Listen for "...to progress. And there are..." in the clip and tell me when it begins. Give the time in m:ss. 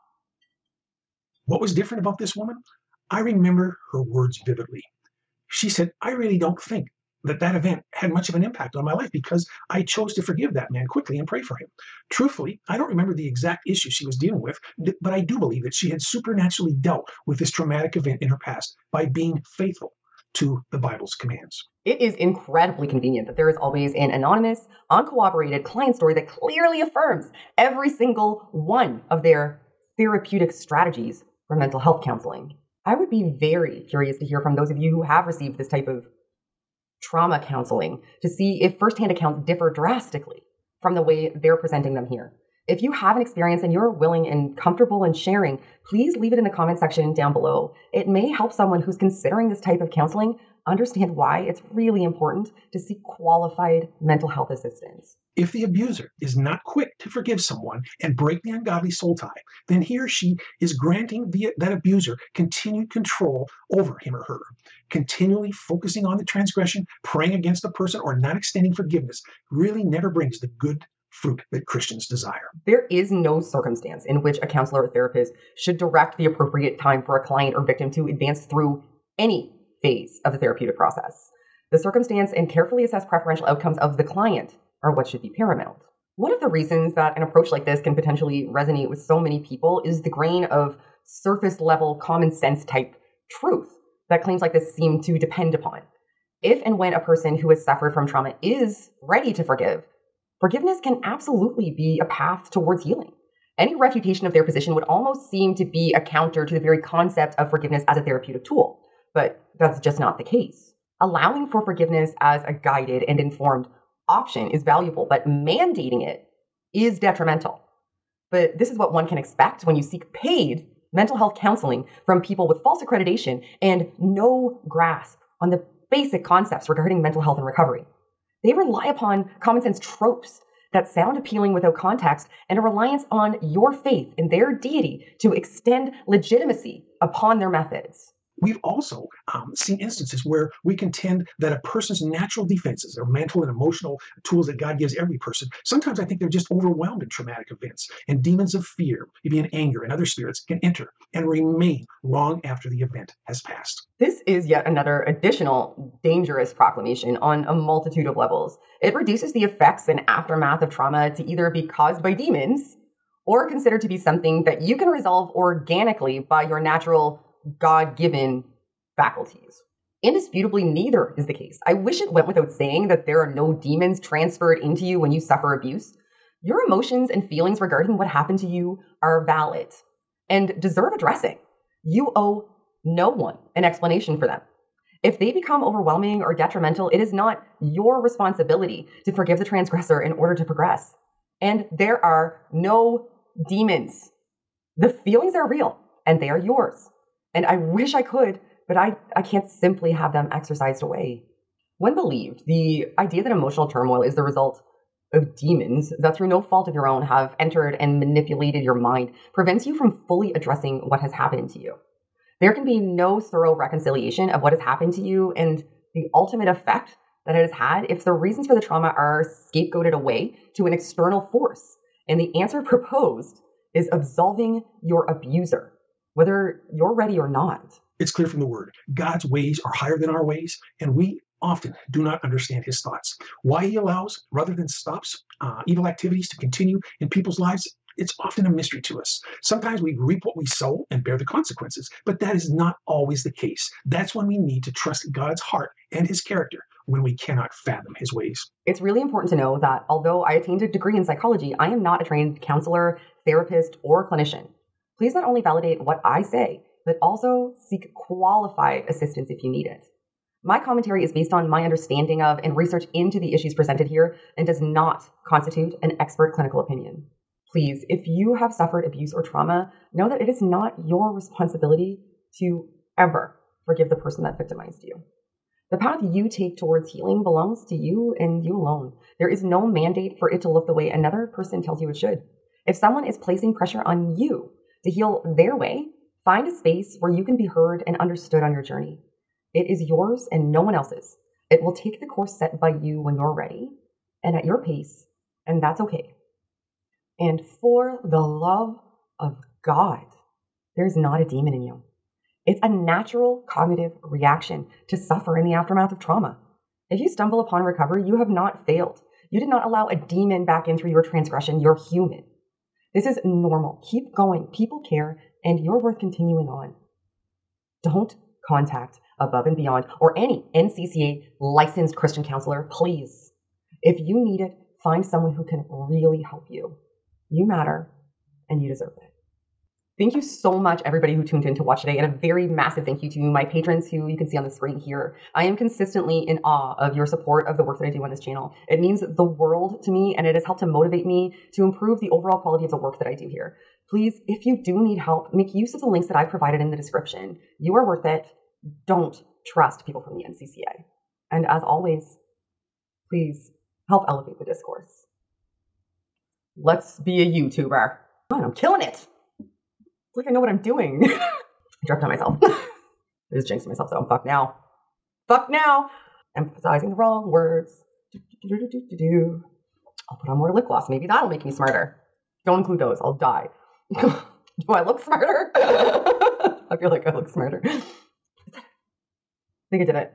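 3:10.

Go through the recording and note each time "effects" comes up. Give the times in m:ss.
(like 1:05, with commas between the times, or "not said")
2:39, 3:36.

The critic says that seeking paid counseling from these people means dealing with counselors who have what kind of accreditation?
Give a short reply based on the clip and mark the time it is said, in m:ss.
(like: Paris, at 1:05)
false accreditation, at 2:02.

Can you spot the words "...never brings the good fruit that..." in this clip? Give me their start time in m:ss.
1:09.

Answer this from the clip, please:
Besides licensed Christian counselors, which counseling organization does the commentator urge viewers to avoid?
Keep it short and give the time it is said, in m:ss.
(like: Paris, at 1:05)
Above and Beyond, at 5:19.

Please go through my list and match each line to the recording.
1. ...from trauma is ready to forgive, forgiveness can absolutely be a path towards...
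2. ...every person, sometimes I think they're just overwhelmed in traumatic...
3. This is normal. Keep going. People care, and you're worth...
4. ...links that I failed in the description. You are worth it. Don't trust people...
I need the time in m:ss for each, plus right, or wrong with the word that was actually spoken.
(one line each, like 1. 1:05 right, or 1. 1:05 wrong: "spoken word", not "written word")
1. 1:37 right
2. 2:24 right
3. 5:12 right
4. 5:45 wrong: "provided", not "failed".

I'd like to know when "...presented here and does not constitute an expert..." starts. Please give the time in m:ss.
4:23.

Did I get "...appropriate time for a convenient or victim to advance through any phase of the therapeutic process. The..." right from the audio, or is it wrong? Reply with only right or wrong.
wrong.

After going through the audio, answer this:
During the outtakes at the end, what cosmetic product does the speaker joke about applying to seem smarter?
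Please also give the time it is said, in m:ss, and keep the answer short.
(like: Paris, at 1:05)
lip gloss, at 6:10.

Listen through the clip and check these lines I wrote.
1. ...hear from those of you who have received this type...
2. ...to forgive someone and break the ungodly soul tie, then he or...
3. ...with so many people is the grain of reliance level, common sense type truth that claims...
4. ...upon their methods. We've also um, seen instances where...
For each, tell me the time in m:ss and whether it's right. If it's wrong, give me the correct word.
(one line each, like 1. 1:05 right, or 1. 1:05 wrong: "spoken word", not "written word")
1. 0:34 right
2. 0:57 right
3. 1:28 wrong: "surface", not "reliance"
4. 2:17 right.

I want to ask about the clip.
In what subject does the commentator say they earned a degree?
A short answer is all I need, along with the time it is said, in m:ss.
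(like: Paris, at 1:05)
psychology, at 4:10.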